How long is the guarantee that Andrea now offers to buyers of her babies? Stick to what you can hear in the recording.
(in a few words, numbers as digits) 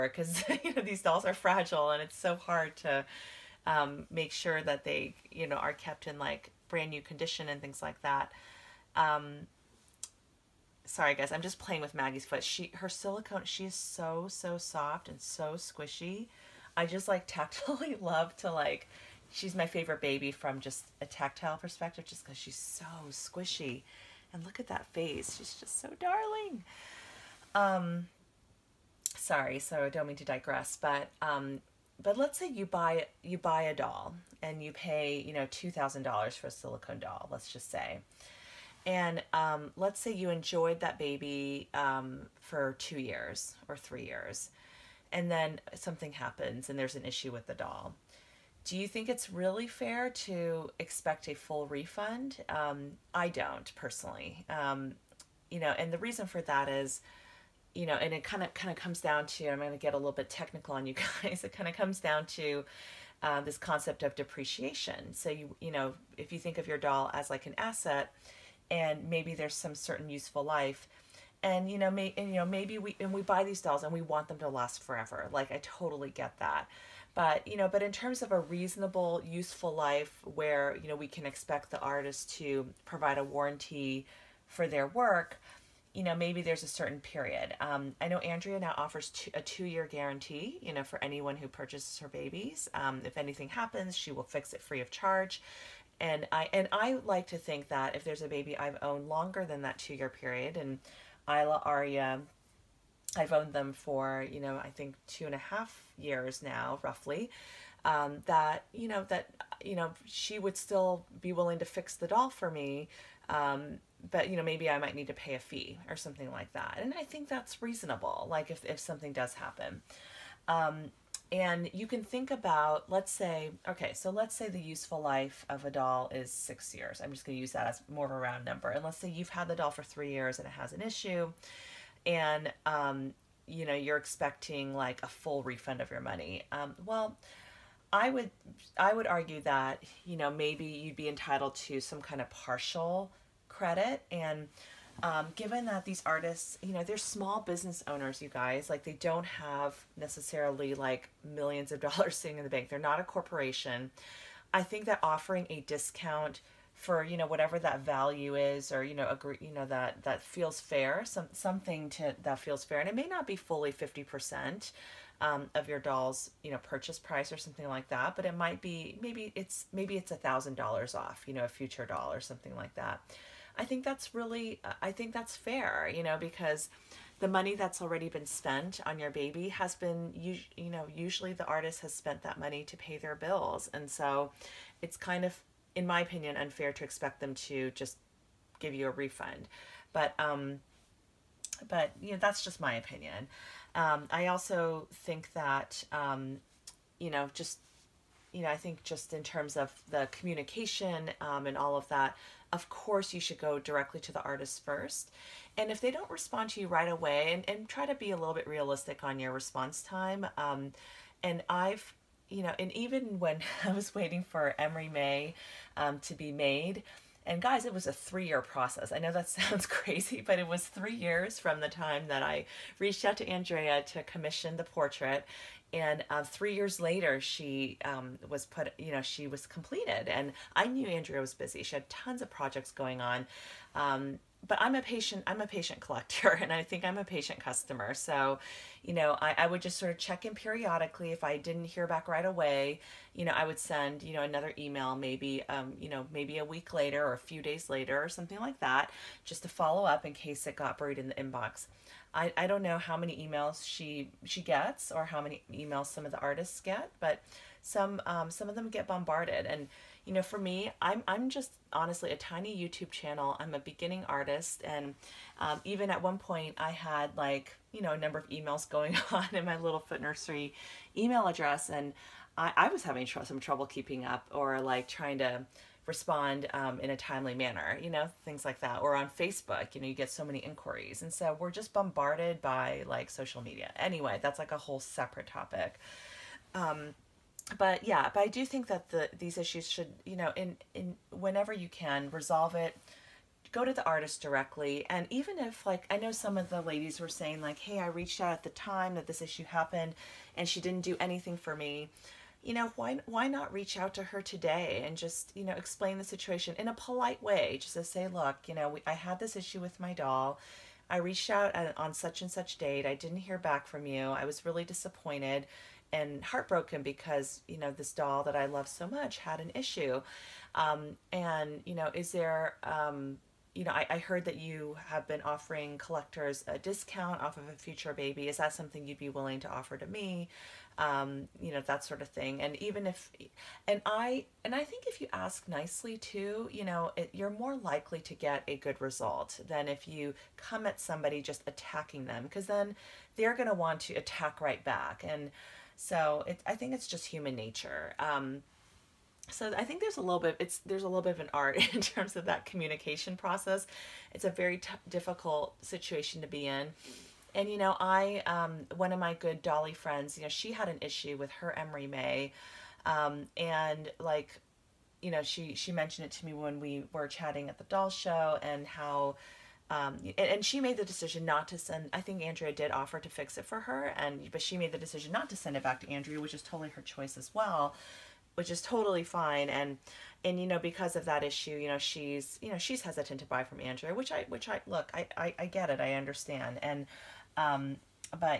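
2 years.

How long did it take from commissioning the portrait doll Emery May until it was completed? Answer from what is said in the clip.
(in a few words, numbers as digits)
3 years.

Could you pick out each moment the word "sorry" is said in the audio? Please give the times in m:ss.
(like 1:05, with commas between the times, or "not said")
0:10, 0:29.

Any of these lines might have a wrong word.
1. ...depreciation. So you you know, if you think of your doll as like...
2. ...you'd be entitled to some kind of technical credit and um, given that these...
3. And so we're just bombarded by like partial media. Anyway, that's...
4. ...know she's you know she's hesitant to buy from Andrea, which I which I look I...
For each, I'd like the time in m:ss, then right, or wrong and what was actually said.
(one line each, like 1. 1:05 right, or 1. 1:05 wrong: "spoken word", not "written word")
1. 1:04 right
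2. 2:20 wrong: "partial", not "technical"
3. 4:41 wrong: "social", not "partial"
4. 6:21 right.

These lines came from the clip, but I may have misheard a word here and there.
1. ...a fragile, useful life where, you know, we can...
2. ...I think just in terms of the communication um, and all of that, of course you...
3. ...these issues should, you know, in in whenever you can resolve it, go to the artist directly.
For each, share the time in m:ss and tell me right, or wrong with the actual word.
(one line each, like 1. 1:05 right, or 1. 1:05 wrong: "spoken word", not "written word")
1. 1:18 wrong: "reasonable", not "fragile"
2. 3:18 right
3. 4:49 right.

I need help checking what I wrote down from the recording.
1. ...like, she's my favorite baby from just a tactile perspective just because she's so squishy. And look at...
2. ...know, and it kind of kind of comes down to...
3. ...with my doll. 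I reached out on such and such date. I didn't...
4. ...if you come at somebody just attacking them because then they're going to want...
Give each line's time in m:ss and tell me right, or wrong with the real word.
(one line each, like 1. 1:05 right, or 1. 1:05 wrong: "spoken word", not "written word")
1. 0:18 right
2. 0:57 right
3. 5:09 right
4. 5:39 right.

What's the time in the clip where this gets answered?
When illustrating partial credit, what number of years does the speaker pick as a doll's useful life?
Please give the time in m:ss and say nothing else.
2:06.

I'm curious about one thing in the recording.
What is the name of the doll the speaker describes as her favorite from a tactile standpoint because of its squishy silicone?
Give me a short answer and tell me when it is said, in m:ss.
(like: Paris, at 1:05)
Maggie, at 0:11.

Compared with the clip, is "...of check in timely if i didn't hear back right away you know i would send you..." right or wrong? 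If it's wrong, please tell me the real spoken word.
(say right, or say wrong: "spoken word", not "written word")
wrong: "periodically", not "timely".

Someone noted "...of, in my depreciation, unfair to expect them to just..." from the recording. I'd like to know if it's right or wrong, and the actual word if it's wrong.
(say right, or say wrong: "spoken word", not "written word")
wrong: "opinion", not "depreciation".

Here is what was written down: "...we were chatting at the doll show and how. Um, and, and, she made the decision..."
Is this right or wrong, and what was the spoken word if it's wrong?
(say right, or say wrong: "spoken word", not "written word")
right.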